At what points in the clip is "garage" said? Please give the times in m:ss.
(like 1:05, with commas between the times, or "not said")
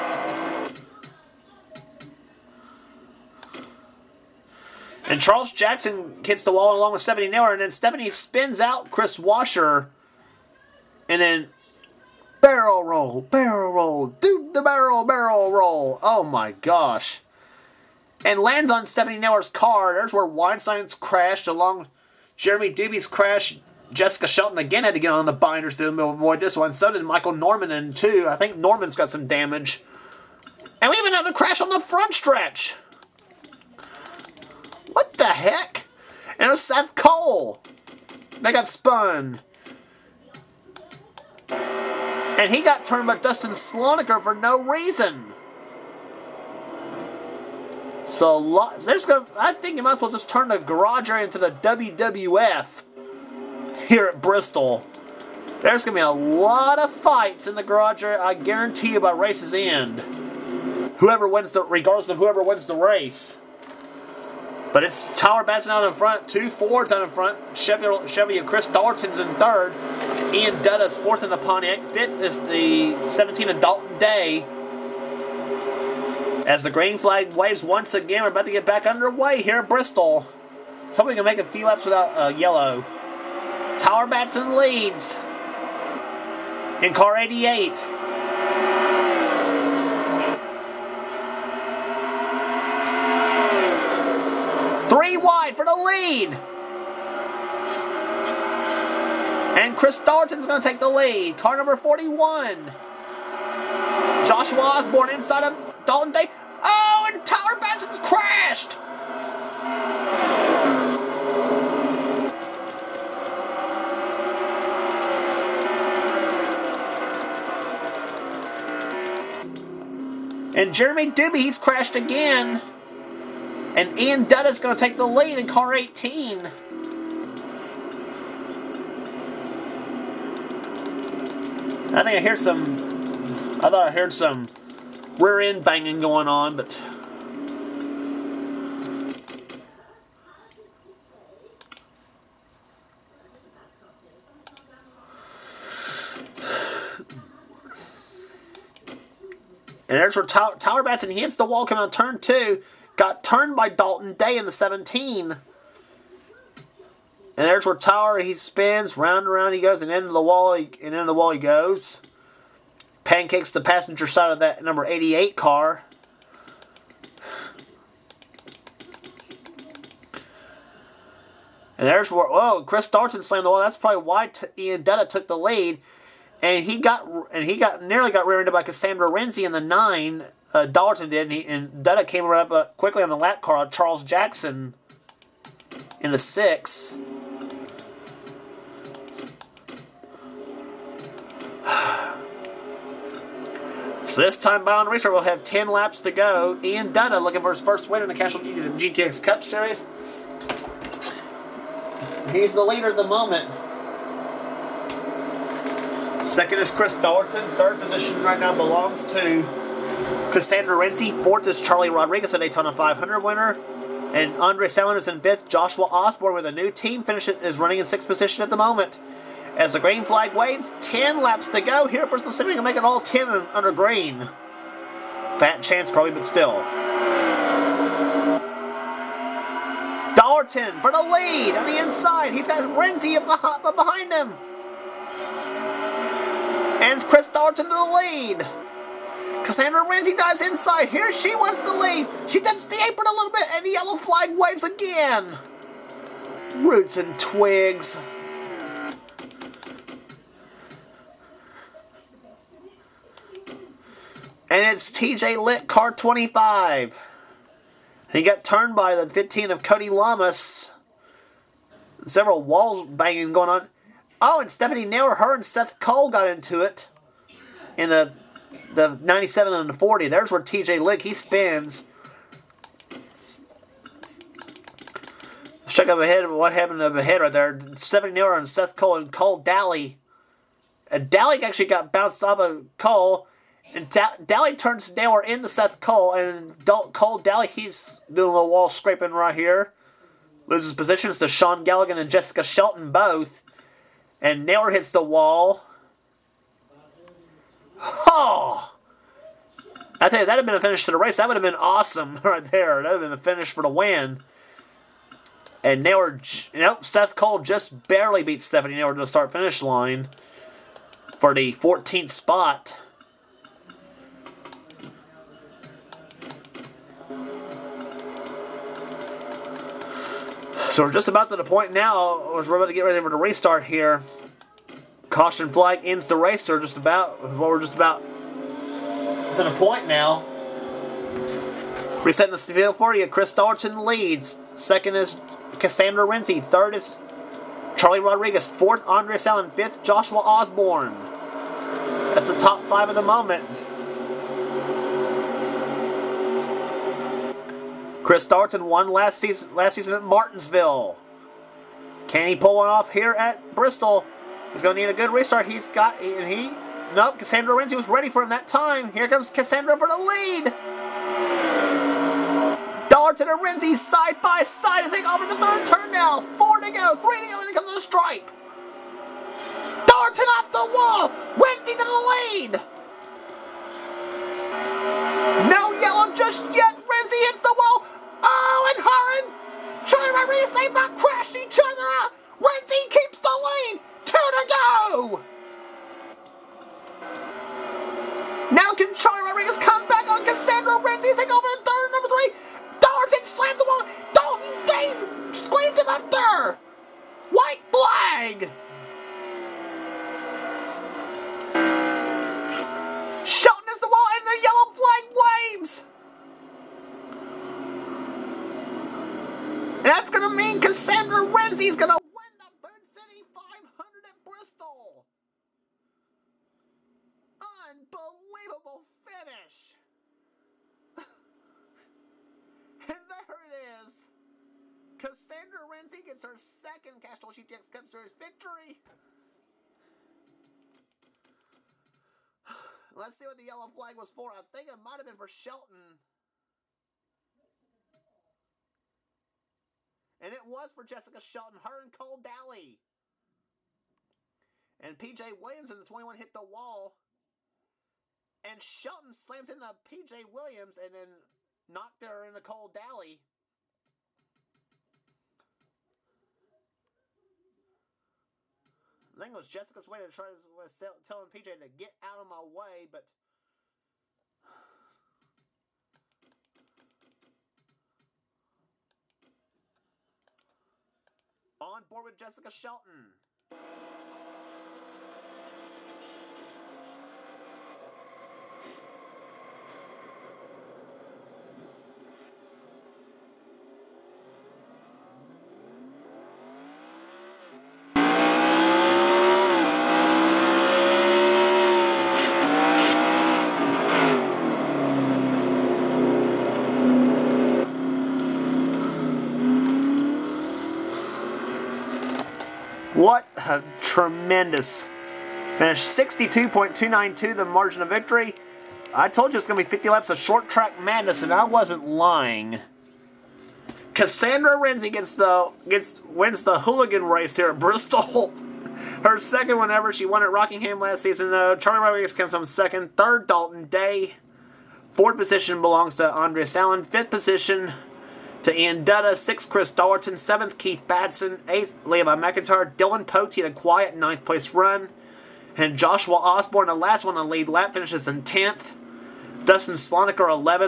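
0:50, 0:57.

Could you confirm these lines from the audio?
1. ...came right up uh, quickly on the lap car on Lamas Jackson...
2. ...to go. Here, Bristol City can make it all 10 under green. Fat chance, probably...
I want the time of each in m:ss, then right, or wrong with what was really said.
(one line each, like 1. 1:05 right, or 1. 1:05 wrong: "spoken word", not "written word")
1. 3:02 wrong: "Charles", not "Lamas"
2. 3:41 right.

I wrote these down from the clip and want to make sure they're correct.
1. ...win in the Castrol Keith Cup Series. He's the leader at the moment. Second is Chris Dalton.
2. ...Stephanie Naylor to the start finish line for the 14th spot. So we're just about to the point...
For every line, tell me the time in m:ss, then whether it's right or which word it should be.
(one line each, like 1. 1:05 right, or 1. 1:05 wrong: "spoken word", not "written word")
1. 3:17 wrong: "GTX", not "Keith"
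2. 5:08 right.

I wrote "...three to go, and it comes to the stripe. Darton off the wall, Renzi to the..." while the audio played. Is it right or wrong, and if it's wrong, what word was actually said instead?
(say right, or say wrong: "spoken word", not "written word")
right.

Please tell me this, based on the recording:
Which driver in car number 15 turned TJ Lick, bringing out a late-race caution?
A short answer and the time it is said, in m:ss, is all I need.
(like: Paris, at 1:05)
Cody Lamas, at 4:19.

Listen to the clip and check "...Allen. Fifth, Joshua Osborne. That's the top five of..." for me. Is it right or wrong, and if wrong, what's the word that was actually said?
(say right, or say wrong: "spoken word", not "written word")
right.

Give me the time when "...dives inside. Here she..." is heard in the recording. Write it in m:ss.
4:00.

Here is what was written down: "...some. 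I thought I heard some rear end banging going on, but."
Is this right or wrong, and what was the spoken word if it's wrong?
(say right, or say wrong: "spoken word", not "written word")
right.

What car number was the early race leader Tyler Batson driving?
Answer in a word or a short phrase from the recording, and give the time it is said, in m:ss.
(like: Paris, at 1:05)
88, at 1:26.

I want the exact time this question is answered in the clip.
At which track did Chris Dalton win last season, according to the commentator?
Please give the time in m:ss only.
5:50.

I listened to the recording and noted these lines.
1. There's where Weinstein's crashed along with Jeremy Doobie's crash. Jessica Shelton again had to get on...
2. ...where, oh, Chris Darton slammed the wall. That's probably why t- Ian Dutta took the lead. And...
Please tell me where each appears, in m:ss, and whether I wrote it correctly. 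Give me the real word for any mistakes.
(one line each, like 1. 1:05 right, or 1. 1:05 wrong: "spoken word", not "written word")
1. 0:19 right
2. 2:52 right.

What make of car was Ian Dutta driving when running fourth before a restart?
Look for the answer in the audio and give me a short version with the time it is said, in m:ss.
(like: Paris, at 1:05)
Pontiac, at 1:11.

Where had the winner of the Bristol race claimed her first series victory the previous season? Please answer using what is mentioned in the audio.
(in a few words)
Rockingham.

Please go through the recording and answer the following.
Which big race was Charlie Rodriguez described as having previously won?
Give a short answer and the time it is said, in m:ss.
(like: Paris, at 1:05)
Daytona 500, at 3:32.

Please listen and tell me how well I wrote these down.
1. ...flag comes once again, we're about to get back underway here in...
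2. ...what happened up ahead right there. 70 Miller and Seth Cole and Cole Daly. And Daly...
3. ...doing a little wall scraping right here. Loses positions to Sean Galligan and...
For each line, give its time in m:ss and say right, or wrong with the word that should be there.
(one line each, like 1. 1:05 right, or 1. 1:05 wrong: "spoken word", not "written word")
1. 1:16 wrong: "waves", not "comes"
2. 4:36 right
3. 4:48 right.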